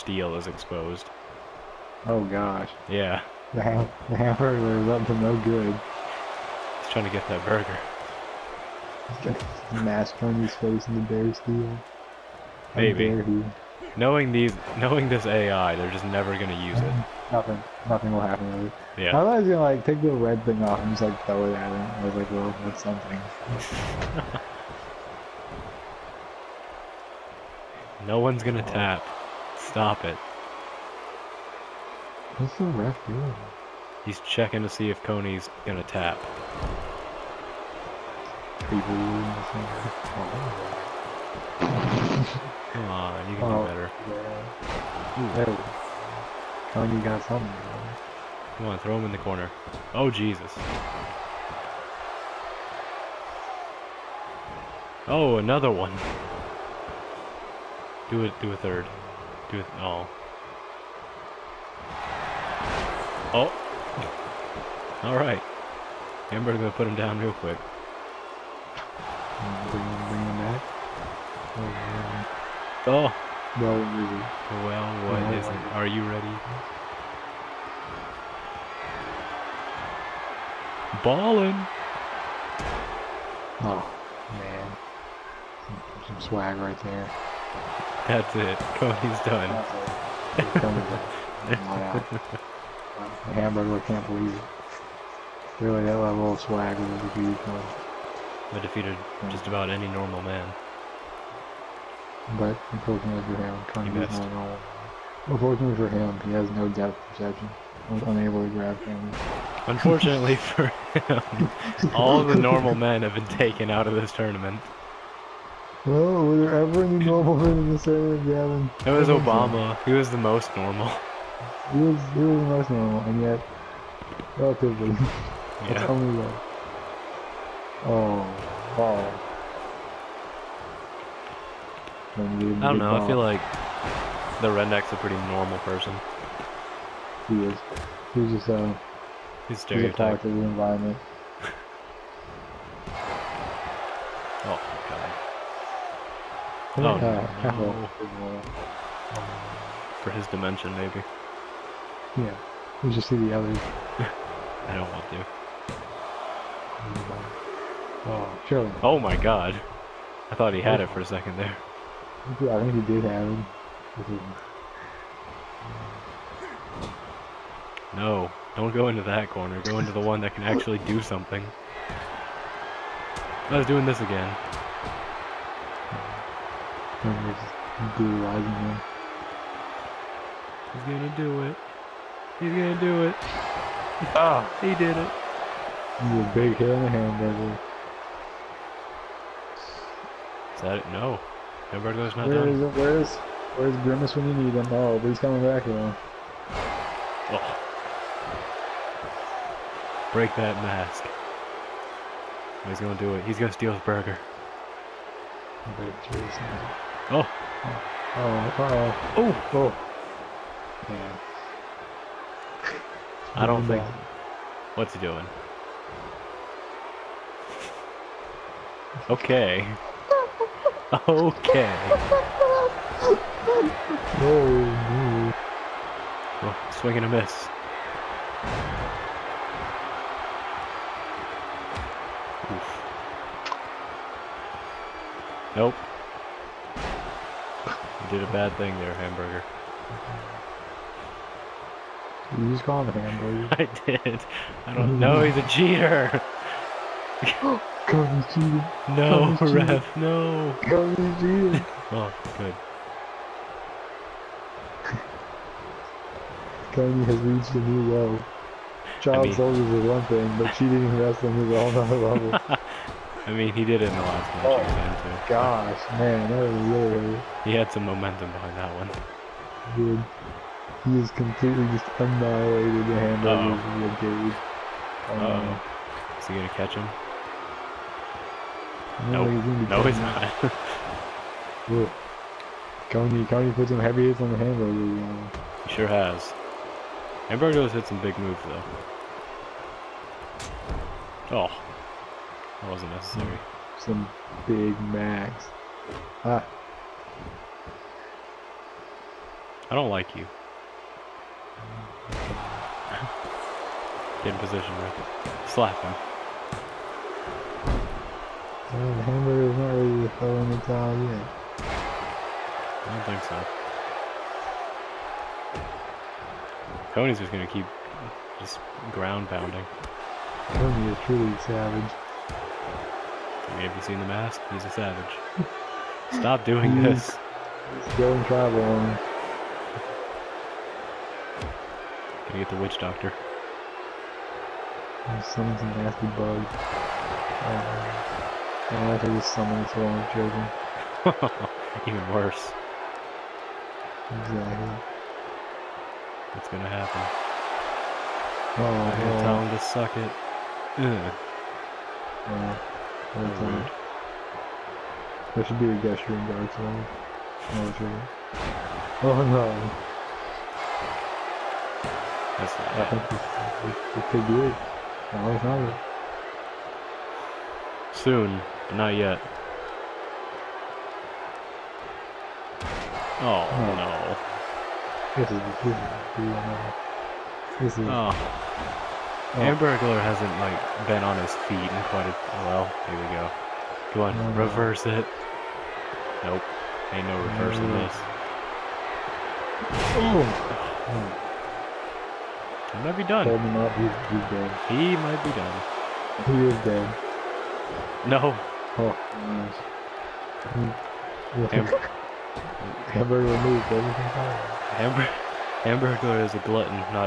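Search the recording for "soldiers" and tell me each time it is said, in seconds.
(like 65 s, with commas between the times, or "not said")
259 s.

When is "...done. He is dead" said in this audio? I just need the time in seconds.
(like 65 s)
395 s.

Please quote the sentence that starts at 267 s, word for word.
He had some momentum behind that one.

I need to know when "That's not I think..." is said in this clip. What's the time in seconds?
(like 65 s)
362 s.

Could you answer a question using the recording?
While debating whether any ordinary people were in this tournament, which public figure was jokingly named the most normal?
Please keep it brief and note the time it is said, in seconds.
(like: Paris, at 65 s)
Obama, at 119 s.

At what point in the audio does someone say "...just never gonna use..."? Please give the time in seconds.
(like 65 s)
15 s.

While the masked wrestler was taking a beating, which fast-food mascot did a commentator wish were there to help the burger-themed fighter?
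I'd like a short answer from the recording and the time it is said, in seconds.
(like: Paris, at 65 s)
Grimace, at 193 s.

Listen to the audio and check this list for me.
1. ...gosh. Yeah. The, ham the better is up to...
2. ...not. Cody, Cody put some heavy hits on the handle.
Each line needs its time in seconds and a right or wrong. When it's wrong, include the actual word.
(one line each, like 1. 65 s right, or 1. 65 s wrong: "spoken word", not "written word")
1. 2 s wrong: "hamburger", not "better"
2. 279 s right.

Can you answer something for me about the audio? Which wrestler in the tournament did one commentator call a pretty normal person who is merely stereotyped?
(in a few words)
The redneck.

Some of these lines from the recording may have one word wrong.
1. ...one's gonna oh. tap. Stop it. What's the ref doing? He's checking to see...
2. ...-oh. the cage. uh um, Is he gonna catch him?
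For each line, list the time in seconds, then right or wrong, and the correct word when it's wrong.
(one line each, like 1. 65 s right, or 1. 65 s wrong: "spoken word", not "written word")
1. 28 s right
2. 273 s right.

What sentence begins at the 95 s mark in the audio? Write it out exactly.
Really, that level of swag was a defeated one.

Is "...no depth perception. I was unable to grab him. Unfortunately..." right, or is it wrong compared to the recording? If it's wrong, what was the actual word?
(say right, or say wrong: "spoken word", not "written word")
right.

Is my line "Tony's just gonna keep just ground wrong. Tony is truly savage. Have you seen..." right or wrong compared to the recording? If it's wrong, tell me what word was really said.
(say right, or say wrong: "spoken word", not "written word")
wrong: "pounding", not "wrong".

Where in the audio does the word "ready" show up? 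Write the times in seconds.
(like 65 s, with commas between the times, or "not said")
76 s, 309 s.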